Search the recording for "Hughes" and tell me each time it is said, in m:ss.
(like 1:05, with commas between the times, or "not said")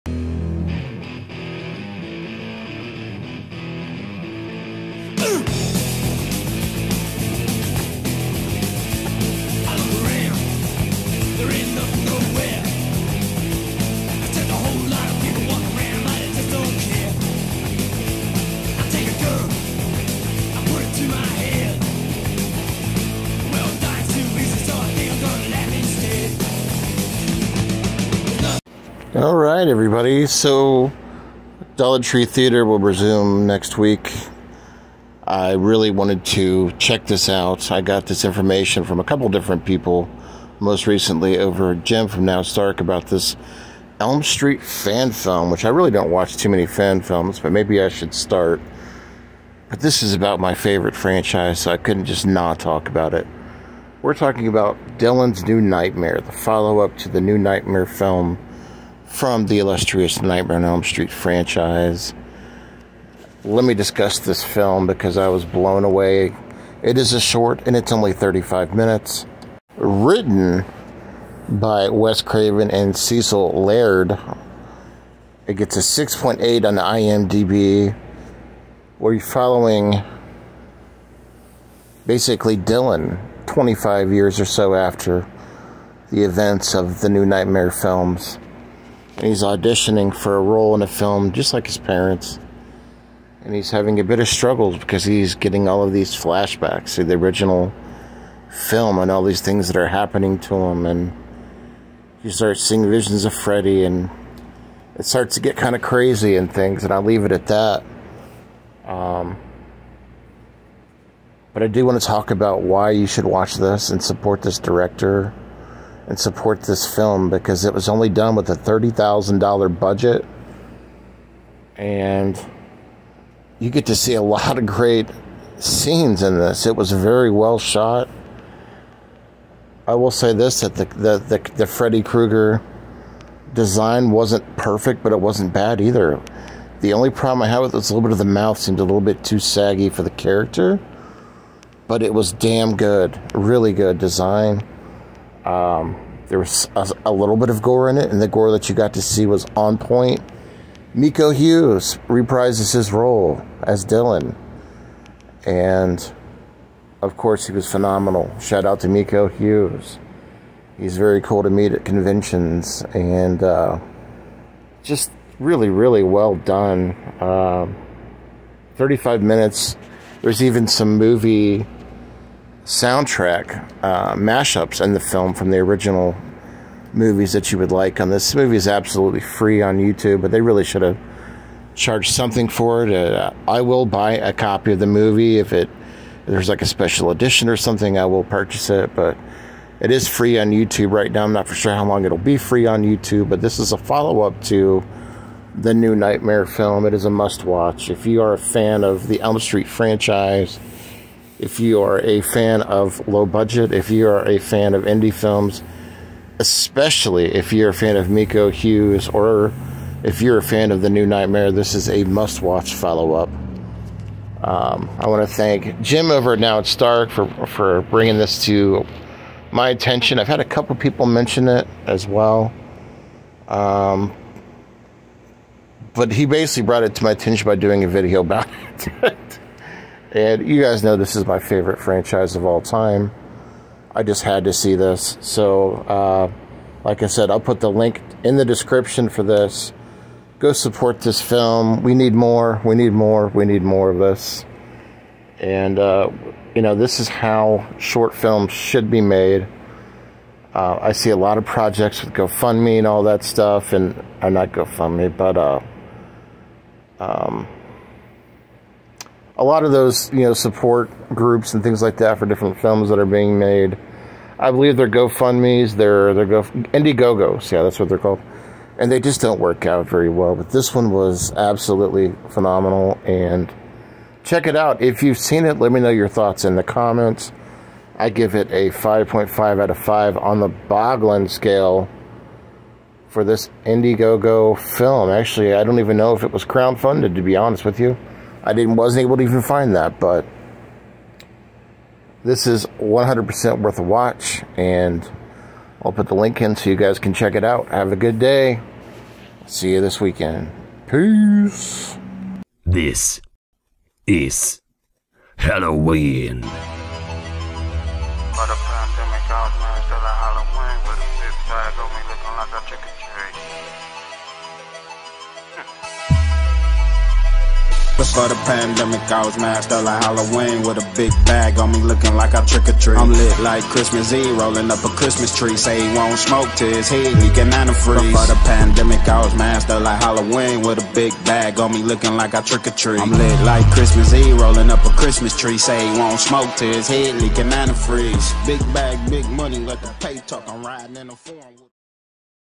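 2:31, 2:39, 3:28.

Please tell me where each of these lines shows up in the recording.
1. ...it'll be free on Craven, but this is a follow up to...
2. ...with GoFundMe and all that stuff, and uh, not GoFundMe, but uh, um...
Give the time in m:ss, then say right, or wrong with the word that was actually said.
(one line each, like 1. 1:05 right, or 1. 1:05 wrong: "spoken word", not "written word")
1. 3:12 wrong: "YouTube", not "Craven"
2. 4:12 right.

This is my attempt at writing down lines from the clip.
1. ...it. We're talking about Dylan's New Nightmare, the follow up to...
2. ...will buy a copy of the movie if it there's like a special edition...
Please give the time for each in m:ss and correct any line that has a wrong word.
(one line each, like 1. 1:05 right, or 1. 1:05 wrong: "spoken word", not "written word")
1. 0:53 right
2. 3:03 right.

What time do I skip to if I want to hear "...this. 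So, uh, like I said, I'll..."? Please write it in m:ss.
3:54.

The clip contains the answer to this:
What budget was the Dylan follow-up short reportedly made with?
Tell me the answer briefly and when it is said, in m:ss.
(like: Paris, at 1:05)
$30,000, at 1:58.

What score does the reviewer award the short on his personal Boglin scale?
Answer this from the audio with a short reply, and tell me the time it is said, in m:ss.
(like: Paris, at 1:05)
5.5 out of 5, at 4:38.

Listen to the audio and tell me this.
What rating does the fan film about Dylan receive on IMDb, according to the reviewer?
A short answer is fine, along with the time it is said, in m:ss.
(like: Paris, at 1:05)
6.8, at 1:15.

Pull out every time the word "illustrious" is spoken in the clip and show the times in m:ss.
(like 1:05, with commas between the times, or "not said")
0:59.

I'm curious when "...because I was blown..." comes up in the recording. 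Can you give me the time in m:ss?
1:04.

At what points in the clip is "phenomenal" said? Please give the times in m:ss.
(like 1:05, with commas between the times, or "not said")
2:37, 4:32.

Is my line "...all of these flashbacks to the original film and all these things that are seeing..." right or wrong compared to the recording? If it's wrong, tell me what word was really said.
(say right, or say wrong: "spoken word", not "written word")
wrong: "happening", not "seeing".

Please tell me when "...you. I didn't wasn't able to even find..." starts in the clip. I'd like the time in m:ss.
4:47.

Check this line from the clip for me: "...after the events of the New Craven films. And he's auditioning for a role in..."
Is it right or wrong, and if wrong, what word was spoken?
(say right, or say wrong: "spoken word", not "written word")
wrong: "Nightmare", not "Craven".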